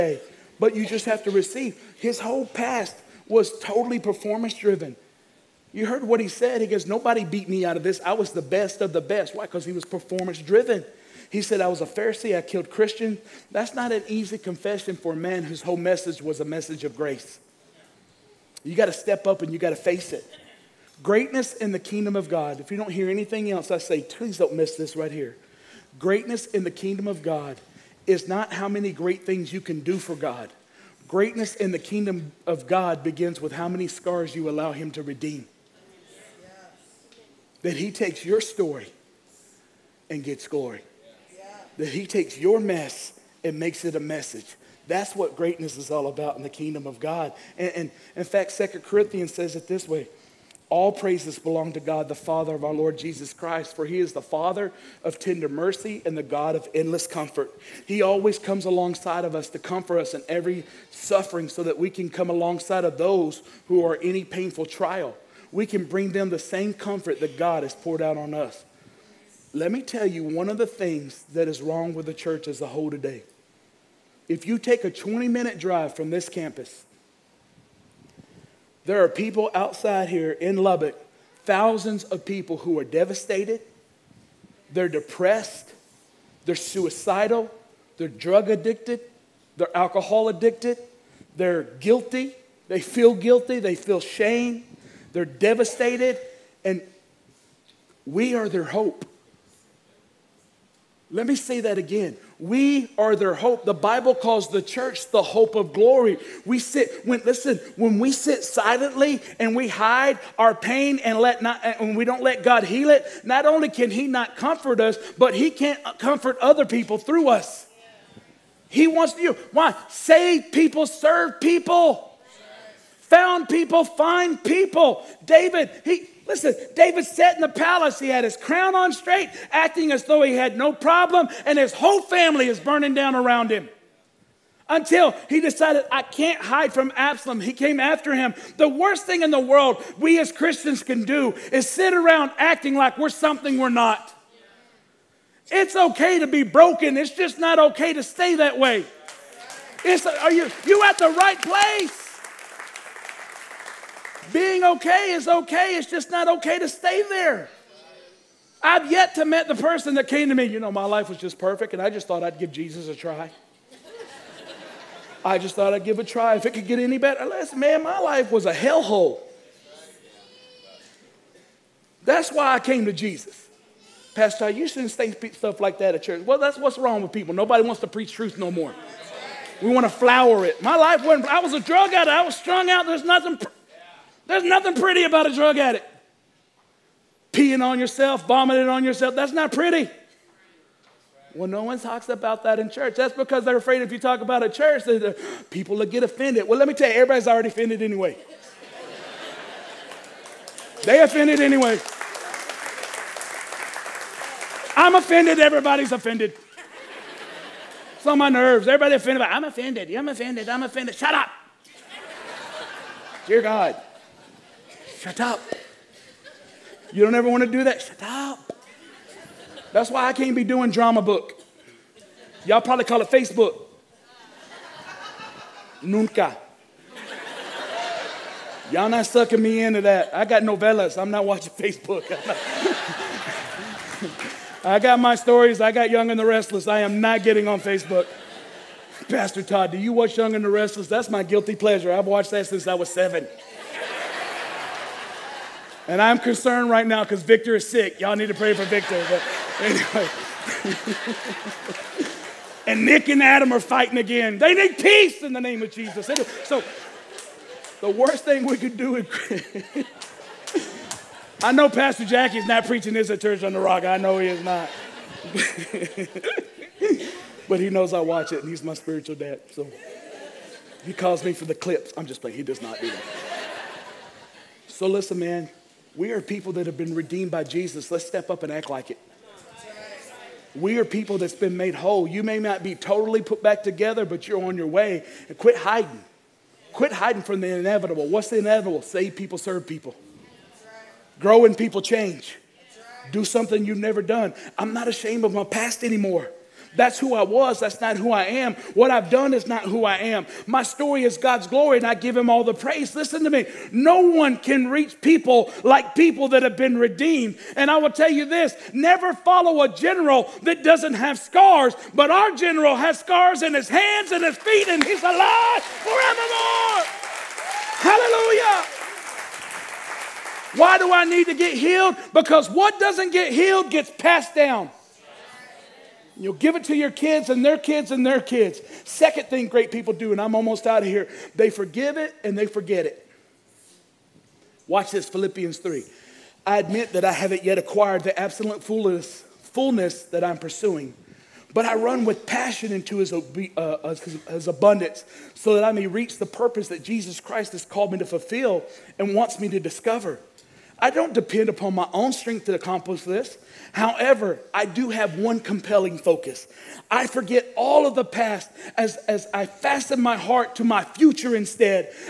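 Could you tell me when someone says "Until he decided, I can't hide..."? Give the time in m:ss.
2:14.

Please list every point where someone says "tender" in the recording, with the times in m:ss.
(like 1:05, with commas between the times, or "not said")
0:55.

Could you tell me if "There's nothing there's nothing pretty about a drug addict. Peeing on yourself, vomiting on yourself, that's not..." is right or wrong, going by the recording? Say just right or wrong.
right.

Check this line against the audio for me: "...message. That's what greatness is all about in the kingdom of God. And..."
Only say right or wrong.
right.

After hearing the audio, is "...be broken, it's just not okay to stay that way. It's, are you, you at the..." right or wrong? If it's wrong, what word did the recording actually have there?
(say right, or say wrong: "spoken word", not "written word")
right.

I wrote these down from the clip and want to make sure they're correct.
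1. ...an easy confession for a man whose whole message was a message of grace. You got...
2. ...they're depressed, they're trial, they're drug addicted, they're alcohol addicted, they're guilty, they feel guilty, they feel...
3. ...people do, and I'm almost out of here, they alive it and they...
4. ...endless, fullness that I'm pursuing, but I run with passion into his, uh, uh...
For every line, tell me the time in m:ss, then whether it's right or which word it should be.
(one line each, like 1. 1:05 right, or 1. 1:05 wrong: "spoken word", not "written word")
1. 0:13 right
2. 1:24 wrong: "suicidal", not "trial"
3. 5:29 wrong: "forgive", not "alive"
4. 5:38 wrong: "fullness", not "endless".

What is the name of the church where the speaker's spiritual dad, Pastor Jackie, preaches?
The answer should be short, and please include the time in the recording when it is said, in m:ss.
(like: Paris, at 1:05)
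Church on the Rock, at 4:23.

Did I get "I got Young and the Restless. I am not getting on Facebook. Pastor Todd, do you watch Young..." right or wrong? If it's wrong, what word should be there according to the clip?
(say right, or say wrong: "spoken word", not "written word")
right.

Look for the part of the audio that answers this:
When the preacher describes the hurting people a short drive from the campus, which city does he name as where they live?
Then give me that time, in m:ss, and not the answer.
1:20.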